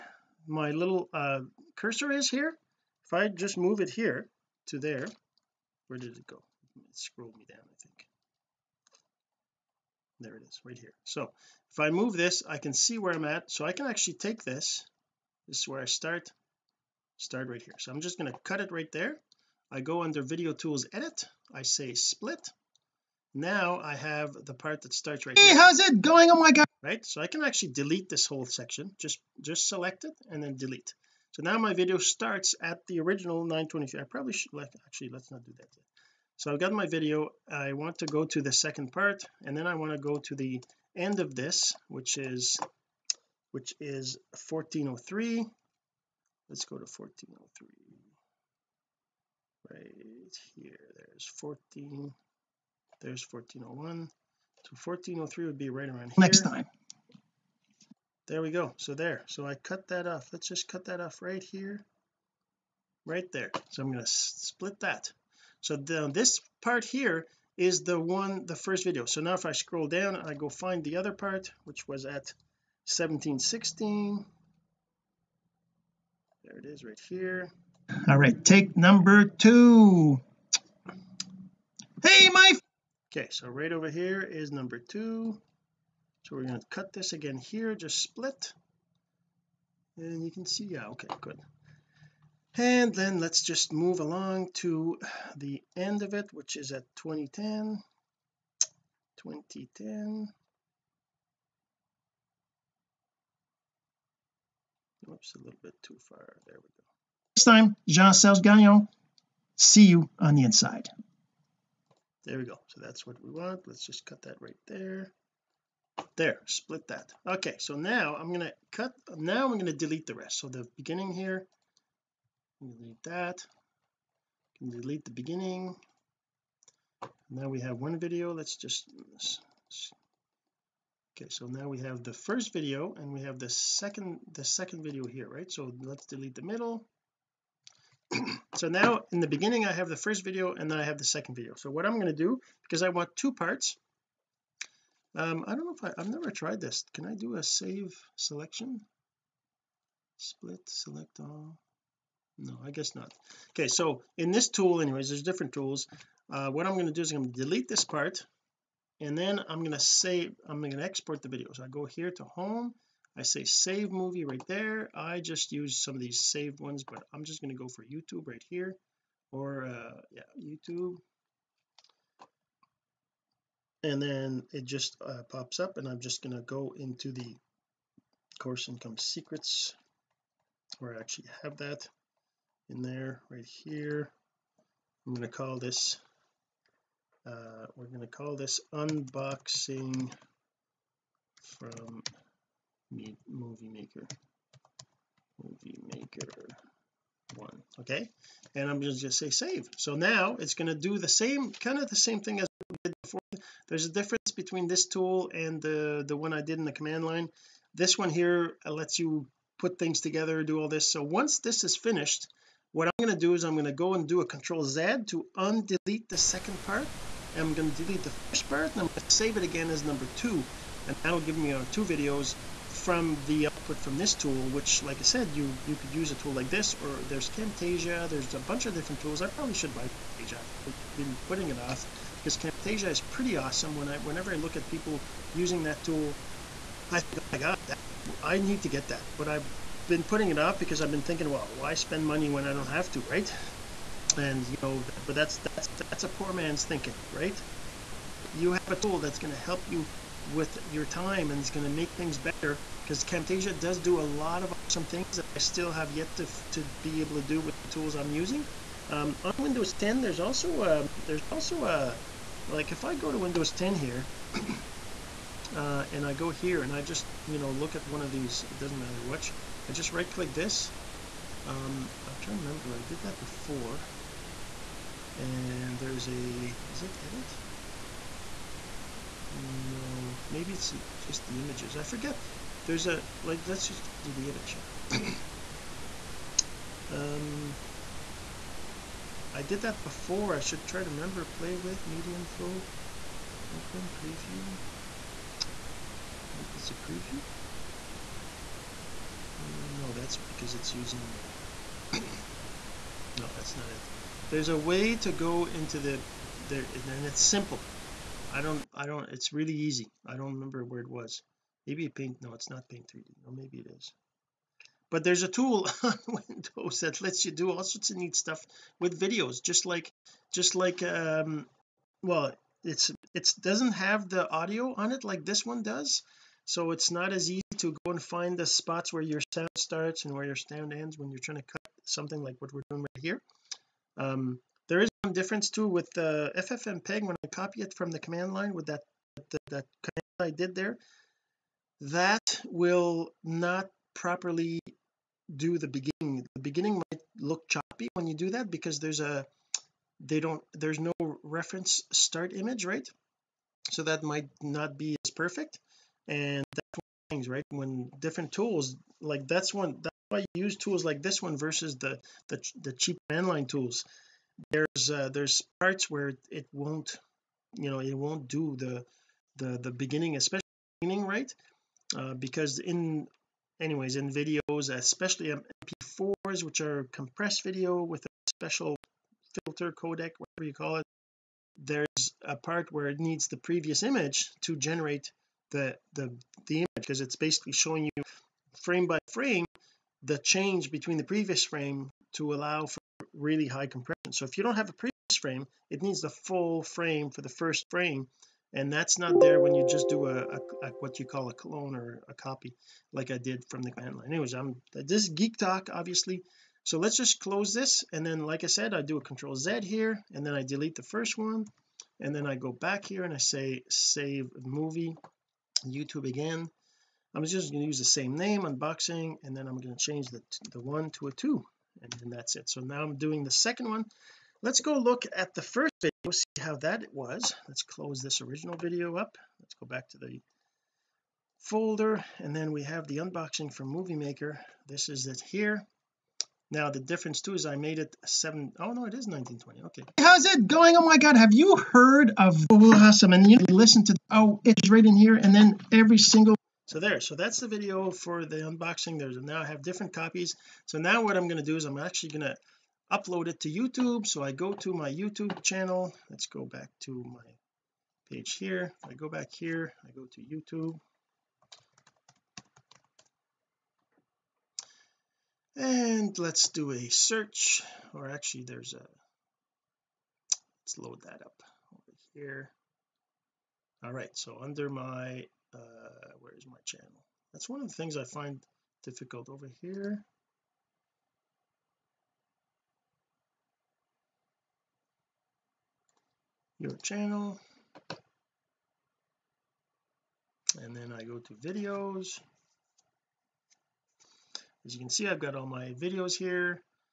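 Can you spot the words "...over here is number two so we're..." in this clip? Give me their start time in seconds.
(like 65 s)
83 s.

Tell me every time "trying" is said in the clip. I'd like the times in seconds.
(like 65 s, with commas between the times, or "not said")
272 s, 331 s.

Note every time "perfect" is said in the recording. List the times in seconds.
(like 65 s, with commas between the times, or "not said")
355 s.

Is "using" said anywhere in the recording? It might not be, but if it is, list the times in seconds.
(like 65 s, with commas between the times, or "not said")
235 s, 258 s, 300 s.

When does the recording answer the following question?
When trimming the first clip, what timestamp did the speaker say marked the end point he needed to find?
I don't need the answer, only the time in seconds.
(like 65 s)
43 s.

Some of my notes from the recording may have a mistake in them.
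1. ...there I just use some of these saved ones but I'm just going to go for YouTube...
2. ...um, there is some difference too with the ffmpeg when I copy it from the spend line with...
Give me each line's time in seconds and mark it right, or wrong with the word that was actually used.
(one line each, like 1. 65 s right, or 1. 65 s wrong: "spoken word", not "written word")
1. 164 s right
2. 333 s wrong: "command", not "spend".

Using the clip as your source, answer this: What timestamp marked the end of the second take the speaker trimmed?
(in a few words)
2010.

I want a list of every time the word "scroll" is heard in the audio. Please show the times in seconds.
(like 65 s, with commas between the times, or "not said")
6 s, 69 s.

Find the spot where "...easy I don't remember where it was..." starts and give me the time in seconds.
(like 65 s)
309 s.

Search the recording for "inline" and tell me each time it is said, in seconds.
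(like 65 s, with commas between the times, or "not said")
363 s.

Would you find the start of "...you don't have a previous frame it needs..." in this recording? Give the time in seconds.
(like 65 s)
394 s.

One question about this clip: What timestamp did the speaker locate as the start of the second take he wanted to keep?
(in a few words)
1716.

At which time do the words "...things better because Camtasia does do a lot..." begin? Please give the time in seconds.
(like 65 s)
251 s.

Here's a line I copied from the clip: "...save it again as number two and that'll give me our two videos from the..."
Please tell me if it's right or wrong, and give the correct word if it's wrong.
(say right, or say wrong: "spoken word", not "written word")
right.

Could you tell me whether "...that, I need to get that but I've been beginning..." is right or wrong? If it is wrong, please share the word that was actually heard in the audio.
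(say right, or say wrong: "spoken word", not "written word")
wrong: "putting", not "beginning".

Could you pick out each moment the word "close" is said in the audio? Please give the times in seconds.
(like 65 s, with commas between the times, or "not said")
407 s, 427 s.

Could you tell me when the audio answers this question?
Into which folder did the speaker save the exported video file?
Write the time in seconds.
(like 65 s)
178 s.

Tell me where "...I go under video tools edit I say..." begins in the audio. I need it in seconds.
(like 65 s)
19 s.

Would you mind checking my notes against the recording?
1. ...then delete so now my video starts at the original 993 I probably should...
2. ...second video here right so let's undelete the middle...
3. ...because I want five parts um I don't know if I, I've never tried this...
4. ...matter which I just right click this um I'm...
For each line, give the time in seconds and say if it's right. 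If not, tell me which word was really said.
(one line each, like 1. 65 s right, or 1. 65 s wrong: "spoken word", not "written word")
1. 30 s wrong: "923", not "993"
2. 134 s wrong: "delete", not "undelete"
3. 142 s wrong: "two", not "five"
4. 268 s right.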